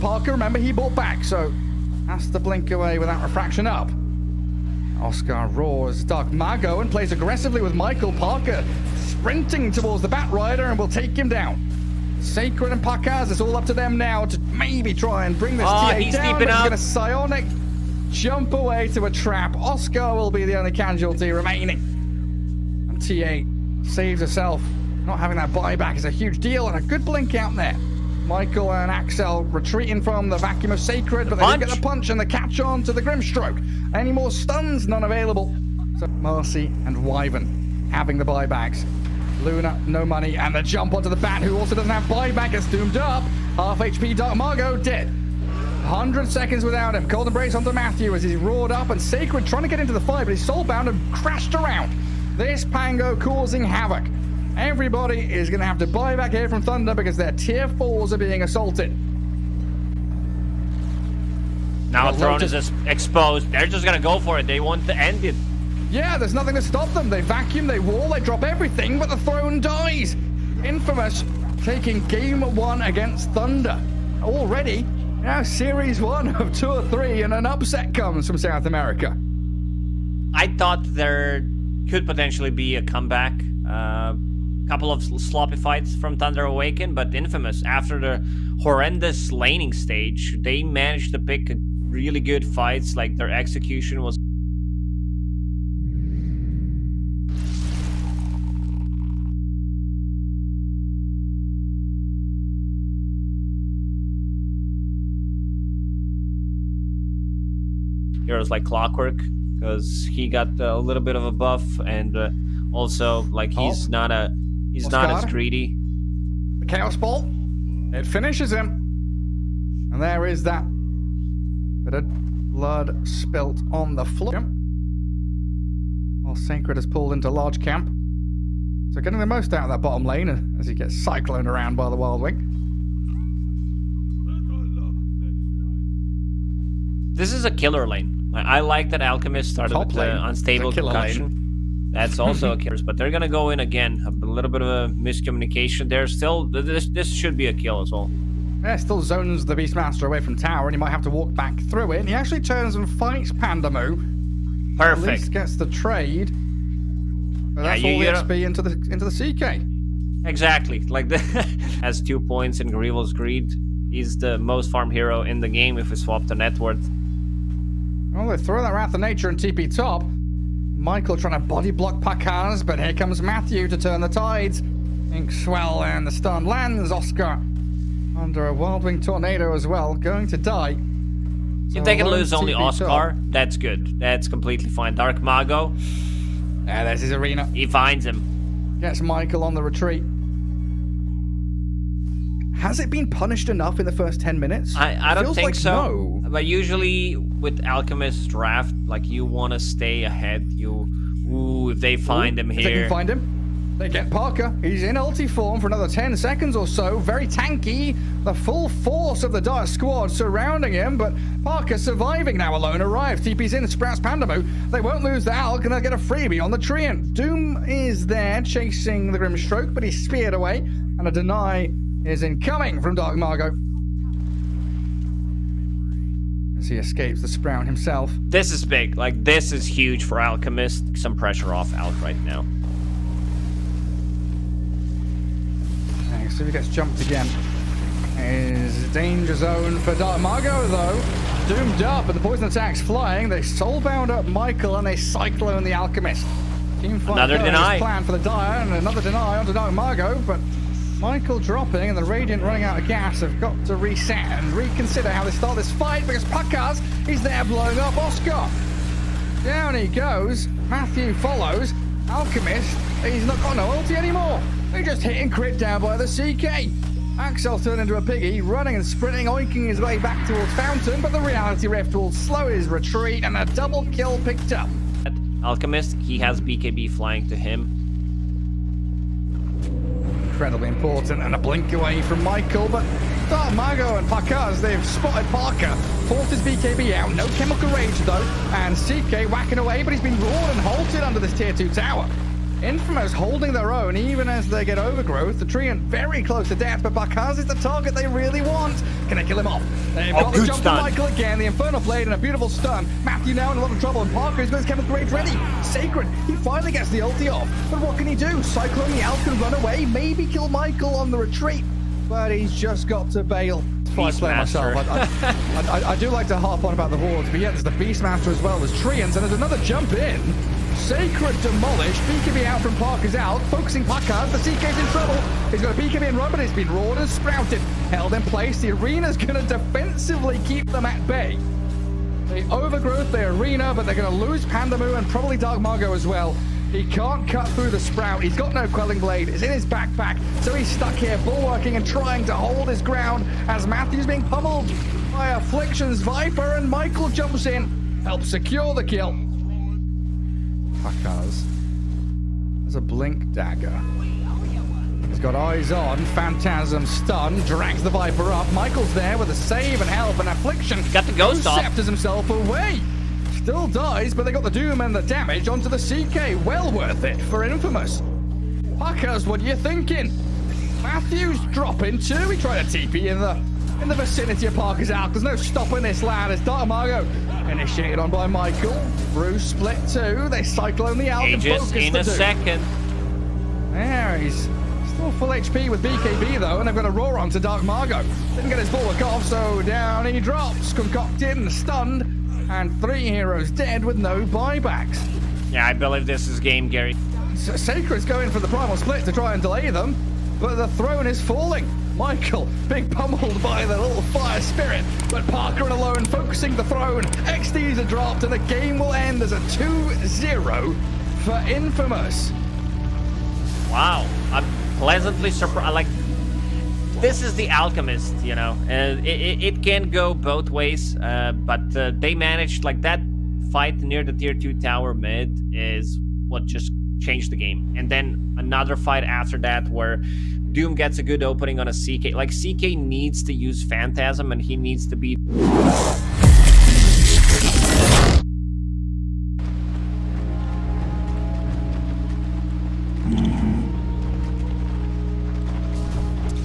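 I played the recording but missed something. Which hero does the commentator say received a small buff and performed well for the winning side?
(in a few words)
Clockwork.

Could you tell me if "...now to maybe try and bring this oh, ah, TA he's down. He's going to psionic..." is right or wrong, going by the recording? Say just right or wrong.
right.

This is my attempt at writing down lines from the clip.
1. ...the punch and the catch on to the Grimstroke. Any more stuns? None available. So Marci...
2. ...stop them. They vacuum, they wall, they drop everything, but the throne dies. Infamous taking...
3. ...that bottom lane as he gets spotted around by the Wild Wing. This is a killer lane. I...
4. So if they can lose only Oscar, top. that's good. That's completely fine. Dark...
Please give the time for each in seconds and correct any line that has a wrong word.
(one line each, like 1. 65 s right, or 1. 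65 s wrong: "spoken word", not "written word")
1. 31 s right
2. 66 s right
3. 129 s wrong: "cycloned", not "spotted"
4. 181 s right.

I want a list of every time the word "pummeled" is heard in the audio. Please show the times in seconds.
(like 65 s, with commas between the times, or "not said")
344 s, 402 s.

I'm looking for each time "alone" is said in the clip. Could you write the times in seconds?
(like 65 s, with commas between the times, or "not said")
212 s, 405 s.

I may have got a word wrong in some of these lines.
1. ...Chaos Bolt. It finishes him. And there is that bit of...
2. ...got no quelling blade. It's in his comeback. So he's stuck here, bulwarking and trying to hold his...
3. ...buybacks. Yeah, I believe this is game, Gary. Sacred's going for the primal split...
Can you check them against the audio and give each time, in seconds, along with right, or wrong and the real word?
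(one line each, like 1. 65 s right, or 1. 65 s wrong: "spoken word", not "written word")
1. 116 s right
2. 338 s wrong: "backpack", not "comeback"
3. 394 s right.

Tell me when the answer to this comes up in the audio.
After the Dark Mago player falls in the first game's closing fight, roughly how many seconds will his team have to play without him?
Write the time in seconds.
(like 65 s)
45 s.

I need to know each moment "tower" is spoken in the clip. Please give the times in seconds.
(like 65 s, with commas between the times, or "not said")
150 s, 291 s, 424 s.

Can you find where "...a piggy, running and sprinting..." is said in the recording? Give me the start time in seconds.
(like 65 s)
267 s.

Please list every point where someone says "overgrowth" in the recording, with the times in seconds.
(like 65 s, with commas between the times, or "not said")
294 s, 332 s.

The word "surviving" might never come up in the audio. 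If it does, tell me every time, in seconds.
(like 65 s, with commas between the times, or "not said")
211 s.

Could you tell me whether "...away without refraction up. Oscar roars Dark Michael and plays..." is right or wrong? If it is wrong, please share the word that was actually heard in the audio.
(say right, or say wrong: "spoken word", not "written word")
wrong: "Mago", not "Michael".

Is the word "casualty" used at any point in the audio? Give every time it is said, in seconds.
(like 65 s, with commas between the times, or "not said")
20 s.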